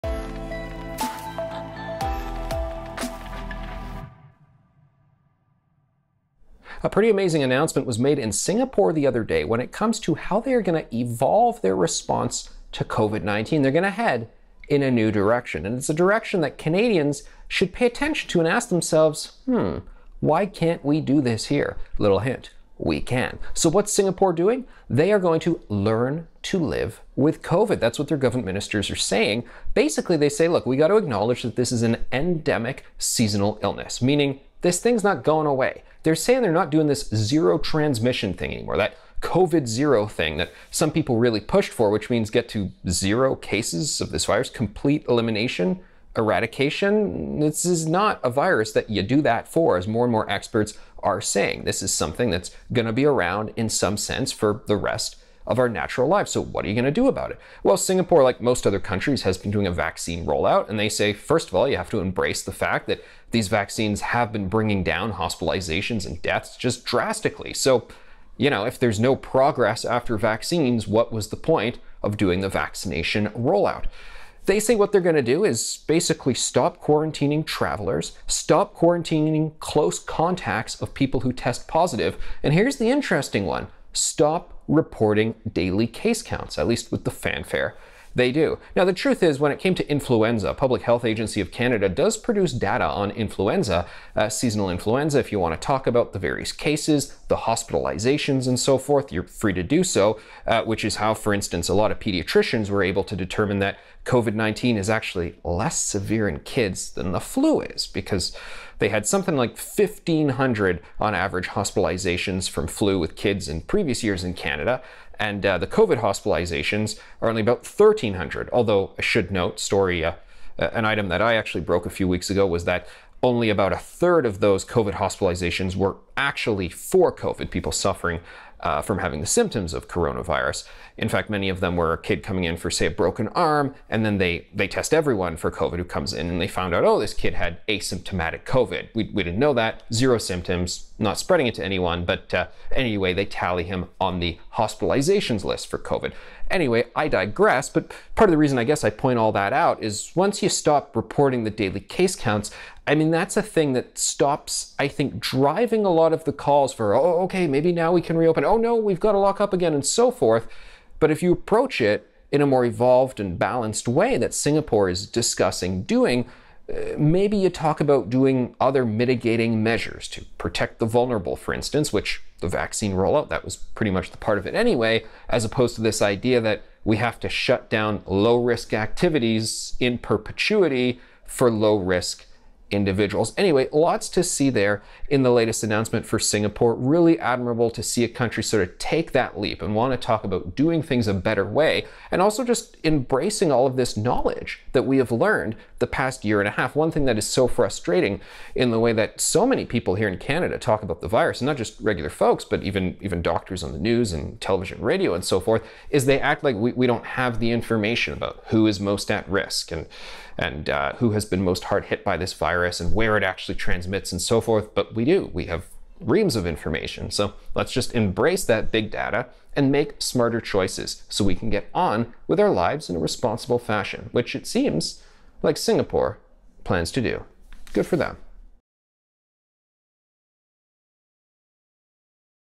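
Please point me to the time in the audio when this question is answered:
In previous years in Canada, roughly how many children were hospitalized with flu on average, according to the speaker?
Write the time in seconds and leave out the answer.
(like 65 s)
109 s.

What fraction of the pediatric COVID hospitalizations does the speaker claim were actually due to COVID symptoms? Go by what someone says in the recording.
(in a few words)
about a third.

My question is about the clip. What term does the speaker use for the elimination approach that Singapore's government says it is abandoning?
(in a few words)
zero transmission.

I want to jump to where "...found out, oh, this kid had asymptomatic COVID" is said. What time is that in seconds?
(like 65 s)
136 s.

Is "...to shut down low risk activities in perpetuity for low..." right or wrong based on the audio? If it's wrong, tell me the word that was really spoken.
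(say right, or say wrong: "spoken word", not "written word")
right.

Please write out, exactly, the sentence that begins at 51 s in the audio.
This is something that's going to be around in some sense for the rest of our natural lives.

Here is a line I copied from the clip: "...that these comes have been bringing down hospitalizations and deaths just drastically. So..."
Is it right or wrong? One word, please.
wrong.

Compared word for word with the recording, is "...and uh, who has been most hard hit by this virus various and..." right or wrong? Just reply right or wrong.
wrong.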